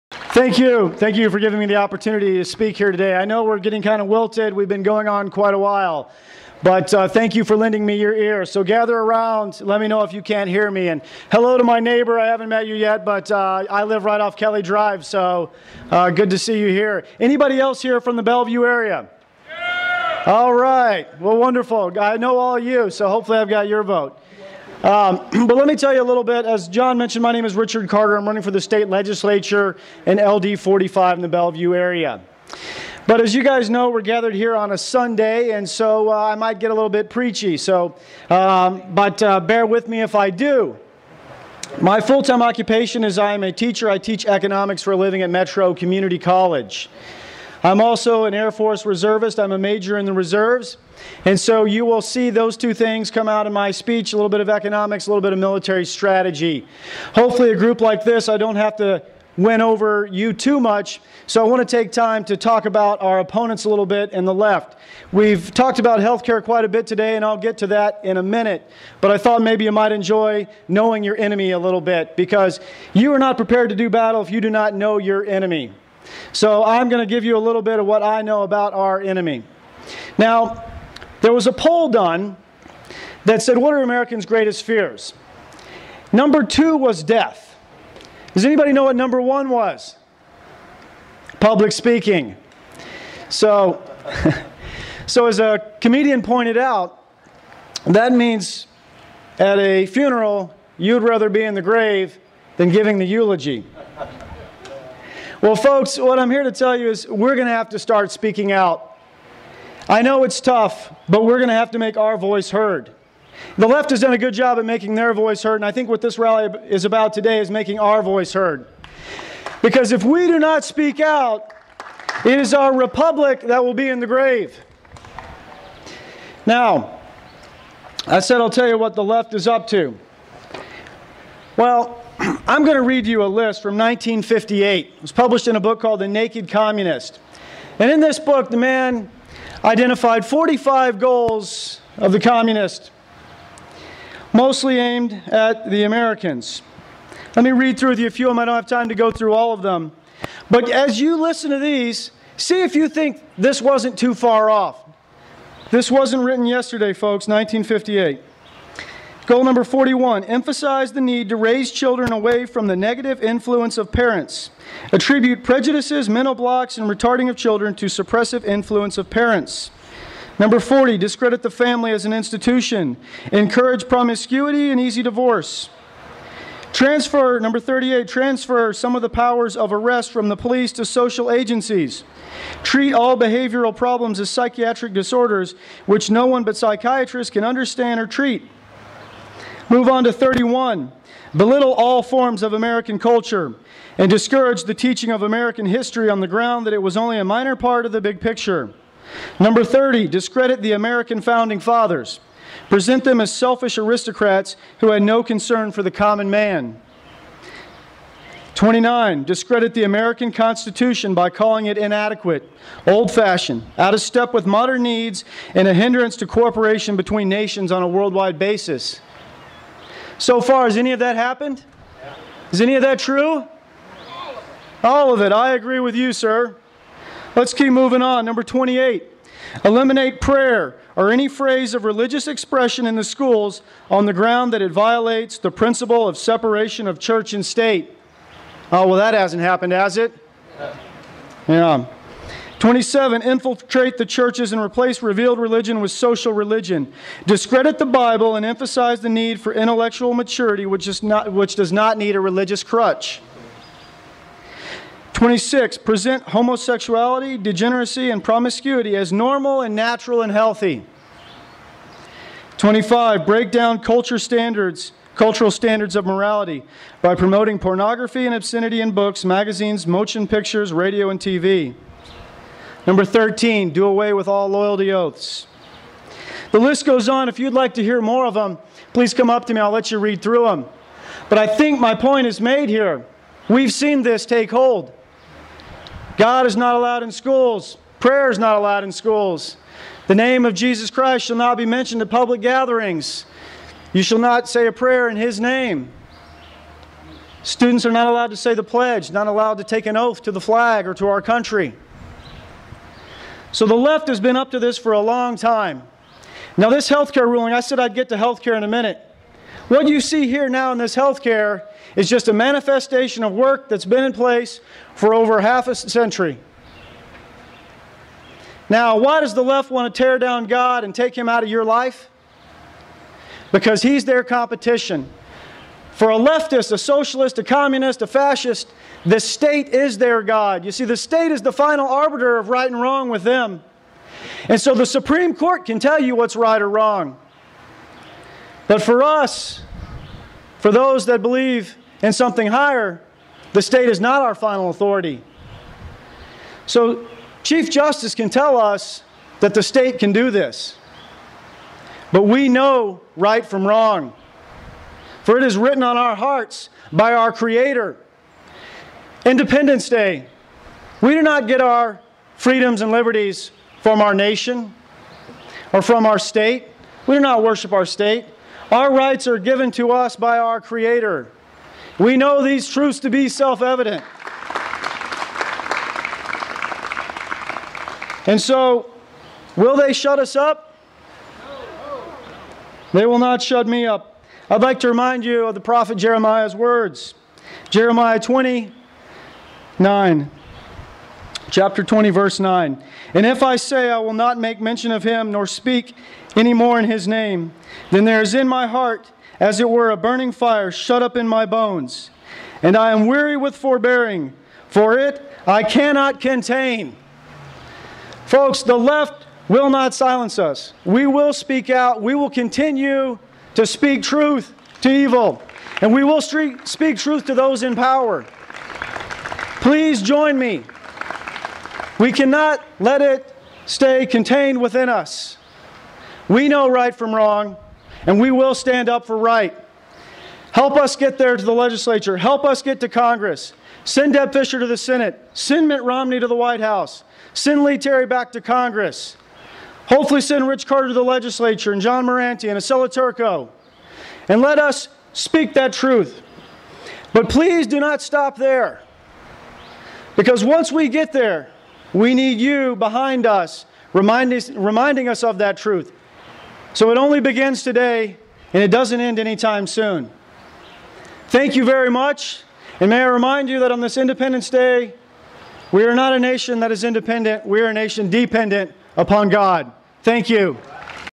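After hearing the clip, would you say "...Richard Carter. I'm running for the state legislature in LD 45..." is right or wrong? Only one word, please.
right.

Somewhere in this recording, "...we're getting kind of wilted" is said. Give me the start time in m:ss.
0:03.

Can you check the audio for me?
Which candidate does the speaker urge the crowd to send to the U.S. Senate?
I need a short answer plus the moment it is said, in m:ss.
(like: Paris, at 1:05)
Deb Fischer, at 7:14.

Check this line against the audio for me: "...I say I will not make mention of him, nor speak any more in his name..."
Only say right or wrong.
right.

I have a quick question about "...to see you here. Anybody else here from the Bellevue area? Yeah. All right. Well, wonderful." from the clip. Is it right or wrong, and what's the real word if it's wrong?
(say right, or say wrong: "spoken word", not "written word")
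right.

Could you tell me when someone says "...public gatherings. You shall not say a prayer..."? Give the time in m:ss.
4:52.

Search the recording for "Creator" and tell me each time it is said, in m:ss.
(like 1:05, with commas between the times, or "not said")
5:57, 6:10.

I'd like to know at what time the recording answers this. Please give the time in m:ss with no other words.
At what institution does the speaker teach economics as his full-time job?
0:45.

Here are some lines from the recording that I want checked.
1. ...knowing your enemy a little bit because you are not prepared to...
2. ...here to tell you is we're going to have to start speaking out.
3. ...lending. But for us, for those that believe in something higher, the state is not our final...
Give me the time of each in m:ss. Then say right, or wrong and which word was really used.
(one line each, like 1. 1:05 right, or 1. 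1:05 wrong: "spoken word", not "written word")
1. 1:10 right
2. 1:46 right
3. 5:36 wrong: "wrong", not "lending".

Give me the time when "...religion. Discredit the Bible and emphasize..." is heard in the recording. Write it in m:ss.
4:06.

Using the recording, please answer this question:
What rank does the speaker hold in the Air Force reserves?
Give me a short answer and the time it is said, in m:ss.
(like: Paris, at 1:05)
Major, at 0:49.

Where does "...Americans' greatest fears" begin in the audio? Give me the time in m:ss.
1:23.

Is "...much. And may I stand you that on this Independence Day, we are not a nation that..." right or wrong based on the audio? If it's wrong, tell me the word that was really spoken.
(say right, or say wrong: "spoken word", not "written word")
wrong: "remind", not "stand".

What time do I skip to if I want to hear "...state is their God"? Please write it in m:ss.
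5:29.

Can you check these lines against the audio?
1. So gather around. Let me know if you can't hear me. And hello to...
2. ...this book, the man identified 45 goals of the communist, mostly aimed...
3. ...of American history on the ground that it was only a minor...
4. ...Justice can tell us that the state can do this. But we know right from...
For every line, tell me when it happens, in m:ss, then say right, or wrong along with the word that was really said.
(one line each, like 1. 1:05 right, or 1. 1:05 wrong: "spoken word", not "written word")
1. 0:08 right
2. 2:17 right
3. 3:15 right
4. 5:47 right.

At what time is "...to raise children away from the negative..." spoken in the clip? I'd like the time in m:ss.
2:41.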